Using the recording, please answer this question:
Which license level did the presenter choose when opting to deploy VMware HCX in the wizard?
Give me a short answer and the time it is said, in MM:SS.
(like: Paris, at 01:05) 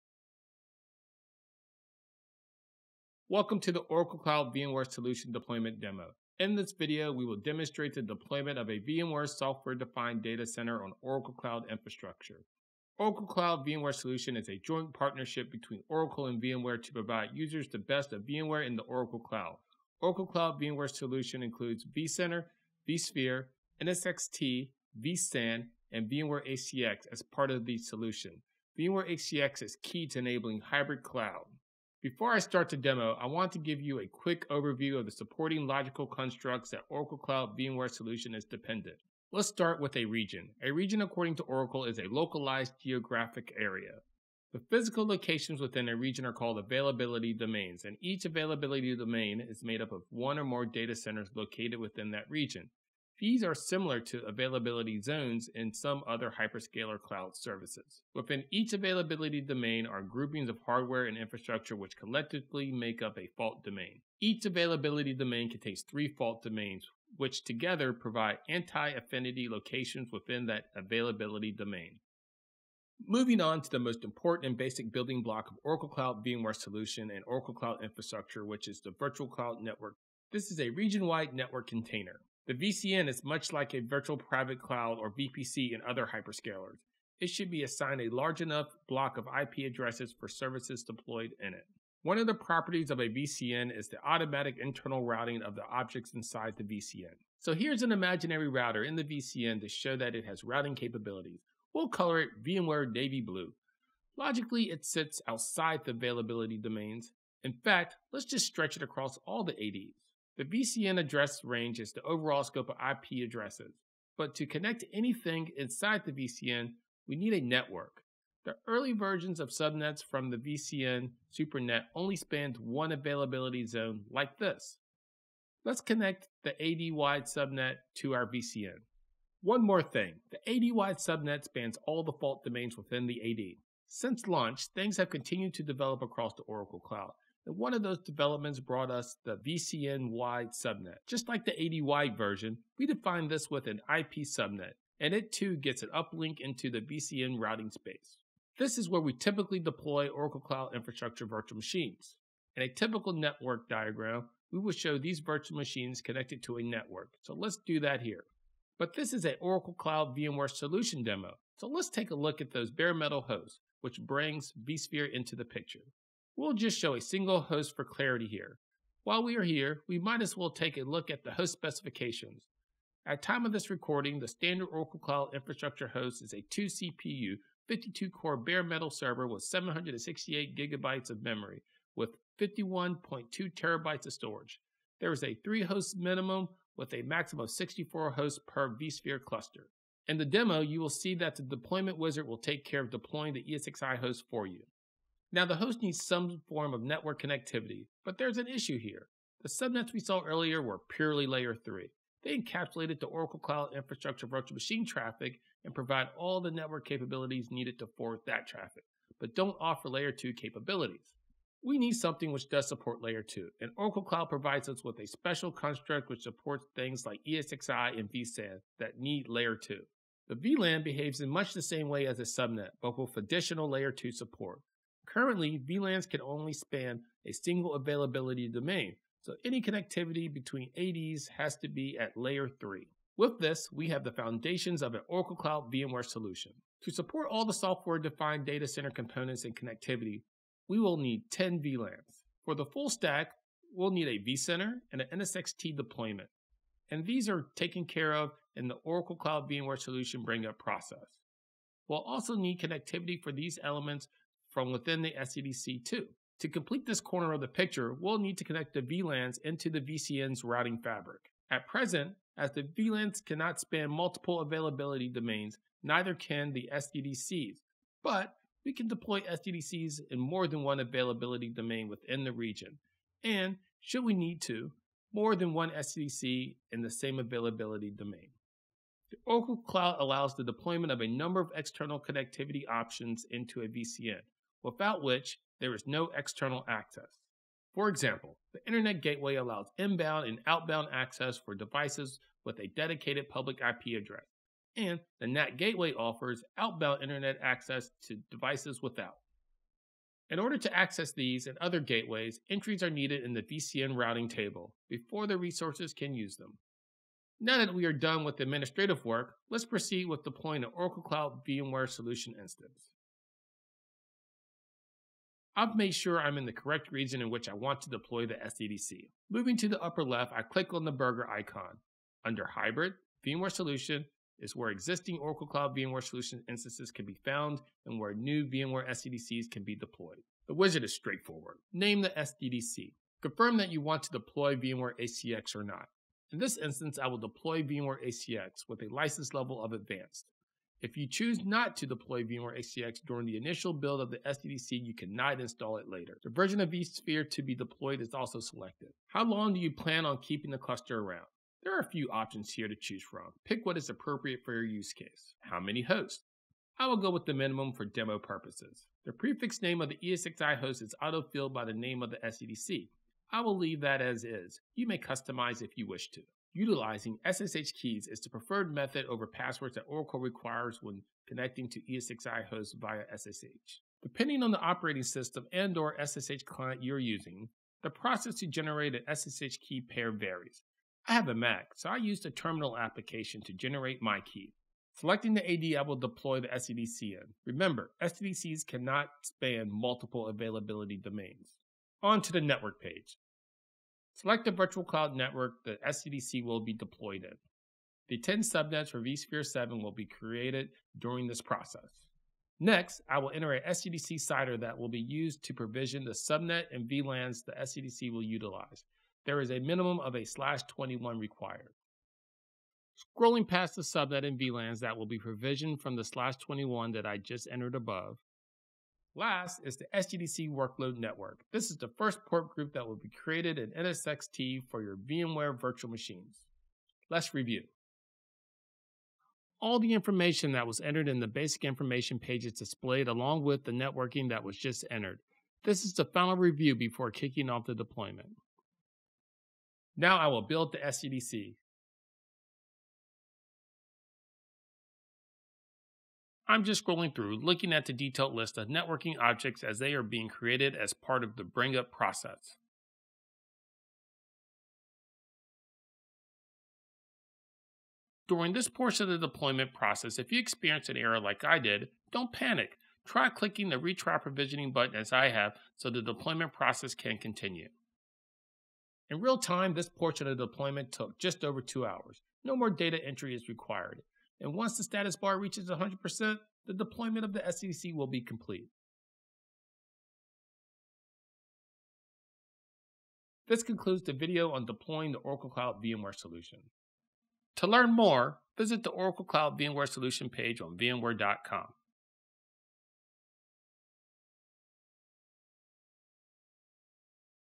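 advanced, at 05:39.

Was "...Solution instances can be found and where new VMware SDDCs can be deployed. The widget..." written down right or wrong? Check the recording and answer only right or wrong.
right.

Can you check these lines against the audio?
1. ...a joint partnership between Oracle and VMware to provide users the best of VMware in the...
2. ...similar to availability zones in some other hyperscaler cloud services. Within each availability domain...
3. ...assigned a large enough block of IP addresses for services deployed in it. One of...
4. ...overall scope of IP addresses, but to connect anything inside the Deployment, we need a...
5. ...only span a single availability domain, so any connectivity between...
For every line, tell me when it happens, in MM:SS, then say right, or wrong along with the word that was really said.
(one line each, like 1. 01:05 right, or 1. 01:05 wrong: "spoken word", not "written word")
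1. 00:14 right
2. 00:53 right
3. 01:27 right
4. 01:52 wrong: "VCN", not "Deployment"
5. 03:46 right.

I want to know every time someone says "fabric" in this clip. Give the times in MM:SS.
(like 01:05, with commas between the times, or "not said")
04:20.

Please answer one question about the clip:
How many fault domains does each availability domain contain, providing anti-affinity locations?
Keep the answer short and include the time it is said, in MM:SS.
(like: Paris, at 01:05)
3, at 01:05.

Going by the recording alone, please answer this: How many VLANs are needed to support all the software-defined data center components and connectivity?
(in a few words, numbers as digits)
10.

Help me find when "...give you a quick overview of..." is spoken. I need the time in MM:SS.
00:33.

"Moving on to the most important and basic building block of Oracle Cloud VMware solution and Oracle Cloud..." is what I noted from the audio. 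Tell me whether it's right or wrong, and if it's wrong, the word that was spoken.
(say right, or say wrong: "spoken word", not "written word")
right.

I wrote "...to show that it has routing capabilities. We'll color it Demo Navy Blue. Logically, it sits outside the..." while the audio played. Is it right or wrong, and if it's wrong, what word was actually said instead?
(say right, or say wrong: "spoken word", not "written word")
wrong: "VMware", not "Demo".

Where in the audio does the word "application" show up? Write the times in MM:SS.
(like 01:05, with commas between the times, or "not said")
06:22.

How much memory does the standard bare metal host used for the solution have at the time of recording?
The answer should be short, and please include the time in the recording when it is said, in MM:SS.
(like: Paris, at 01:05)
768 gigabytes, at 02:59.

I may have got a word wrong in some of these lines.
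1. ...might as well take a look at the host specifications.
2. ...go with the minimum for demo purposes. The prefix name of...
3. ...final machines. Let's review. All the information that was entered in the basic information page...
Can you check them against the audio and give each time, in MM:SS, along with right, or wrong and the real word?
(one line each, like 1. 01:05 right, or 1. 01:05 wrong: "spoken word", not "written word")
1. 02:49 right
2. 05:56 right
3. 07:05 wrong: "virtual", not "final".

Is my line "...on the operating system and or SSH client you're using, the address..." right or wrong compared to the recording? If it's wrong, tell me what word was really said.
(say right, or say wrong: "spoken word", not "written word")
wrong: "process", not "address".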